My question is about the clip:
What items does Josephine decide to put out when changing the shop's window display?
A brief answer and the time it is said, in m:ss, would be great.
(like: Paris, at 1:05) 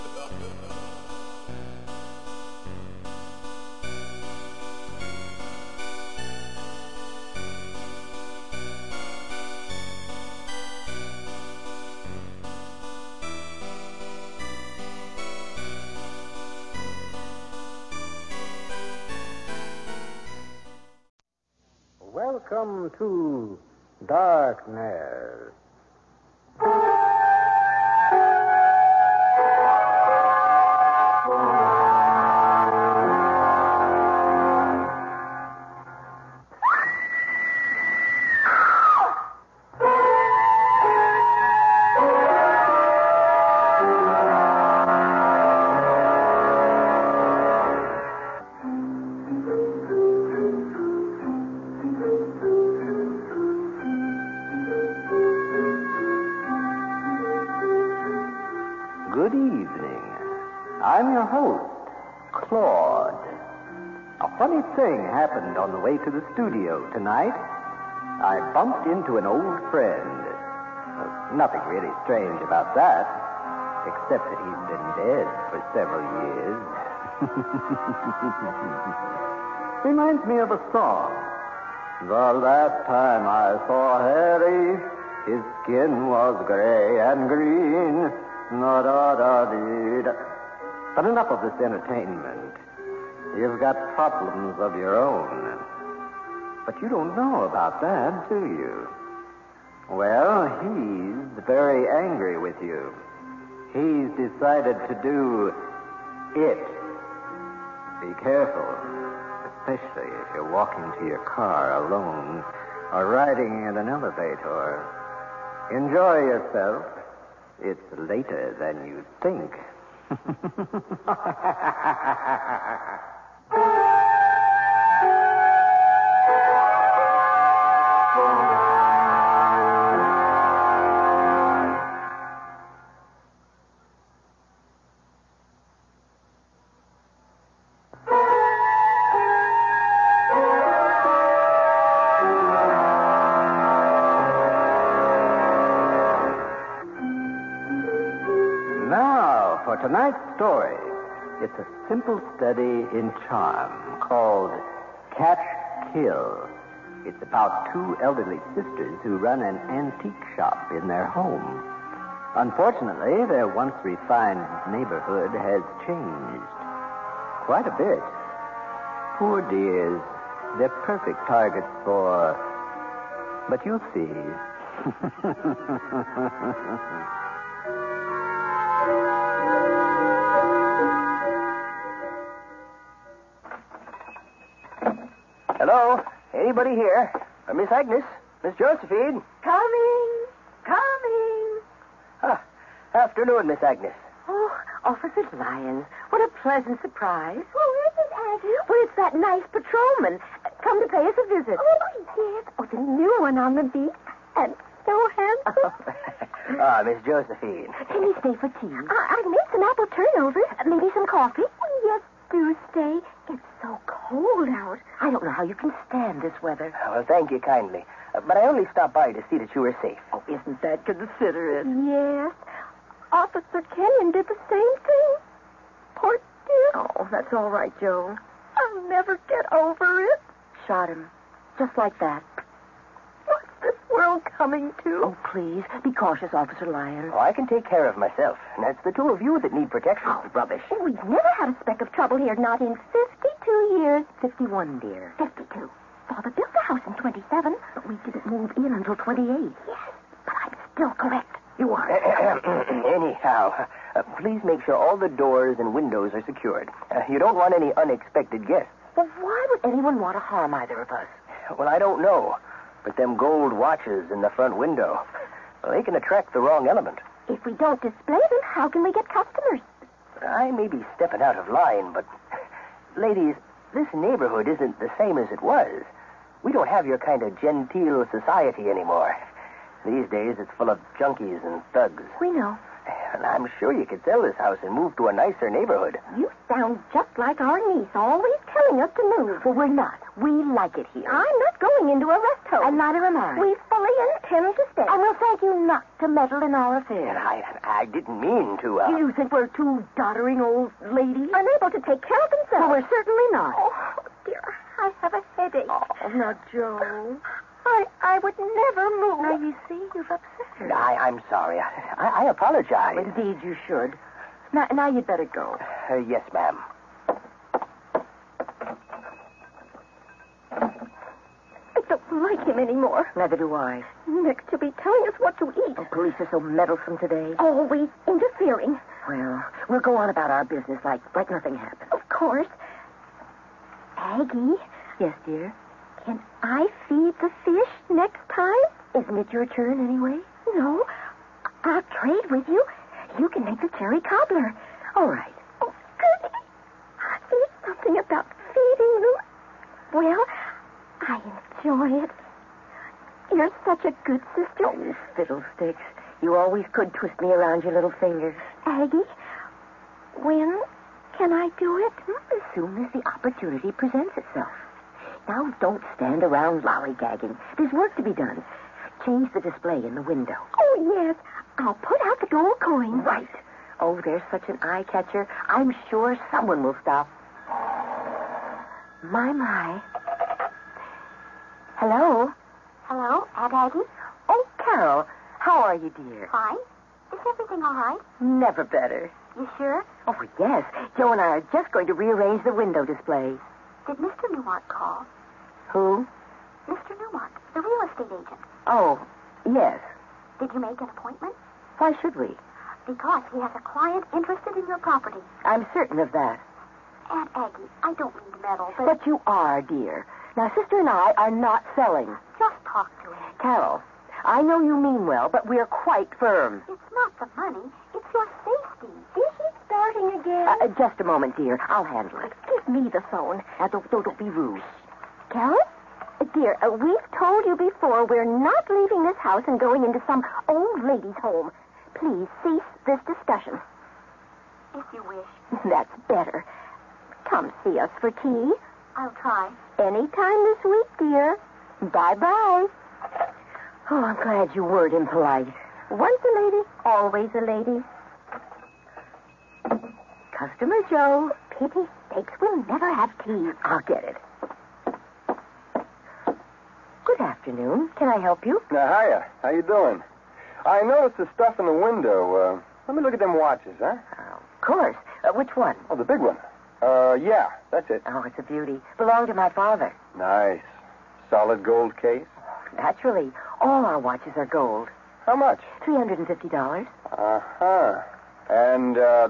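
gold coins, at 6:12.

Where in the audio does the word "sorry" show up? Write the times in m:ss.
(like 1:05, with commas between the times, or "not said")
5:11.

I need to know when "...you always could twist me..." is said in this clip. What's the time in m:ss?
5:56.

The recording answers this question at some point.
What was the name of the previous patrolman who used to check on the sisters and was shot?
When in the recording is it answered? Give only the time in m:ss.
3:43.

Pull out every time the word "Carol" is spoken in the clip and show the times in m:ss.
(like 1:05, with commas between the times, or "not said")
6:24, 6:53, 7:05.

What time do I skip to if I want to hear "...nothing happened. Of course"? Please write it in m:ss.
5:31.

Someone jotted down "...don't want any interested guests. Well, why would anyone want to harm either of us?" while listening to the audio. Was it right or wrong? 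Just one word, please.
wrong.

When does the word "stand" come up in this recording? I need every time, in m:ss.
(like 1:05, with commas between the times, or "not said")
3:35, 6:05.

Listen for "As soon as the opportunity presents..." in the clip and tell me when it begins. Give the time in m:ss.
6:02.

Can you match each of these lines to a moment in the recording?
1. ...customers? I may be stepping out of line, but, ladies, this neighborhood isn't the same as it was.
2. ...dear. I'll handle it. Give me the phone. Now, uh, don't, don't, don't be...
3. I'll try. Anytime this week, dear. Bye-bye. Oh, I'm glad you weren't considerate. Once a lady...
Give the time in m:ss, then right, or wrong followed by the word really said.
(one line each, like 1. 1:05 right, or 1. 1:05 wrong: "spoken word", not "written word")
1. 4:29 right
2. 7:01 right
3. 7:18 wrong: "impolite", not "considerate".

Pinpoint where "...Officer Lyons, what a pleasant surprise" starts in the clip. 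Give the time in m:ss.
3:14.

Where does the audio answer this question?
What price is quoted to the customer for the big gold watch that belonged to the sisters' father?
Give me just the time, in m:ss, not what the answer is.
7:55.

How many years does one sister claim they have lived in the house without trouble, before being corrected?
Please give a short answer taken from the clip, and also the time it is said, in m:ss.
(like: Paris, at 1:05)
52, at 4:02.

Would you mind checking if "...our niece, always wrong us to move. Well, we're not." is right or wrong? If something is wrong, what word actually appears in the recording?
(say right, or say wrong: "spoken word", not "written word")
wrong: "telling", not "wrong".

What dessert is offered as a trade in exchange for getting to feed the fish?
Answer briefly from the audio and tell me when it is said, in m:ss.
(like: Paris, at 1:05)
cherry cobbler, at 5:43.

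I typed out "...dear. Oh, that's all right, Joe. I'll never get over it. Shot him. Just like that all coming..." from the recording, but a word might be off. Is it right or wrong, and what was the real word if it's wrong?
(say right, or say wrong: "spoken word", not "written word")
right.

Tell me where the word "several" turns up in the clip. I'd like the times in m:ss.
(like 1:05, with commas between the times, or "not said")
1:15.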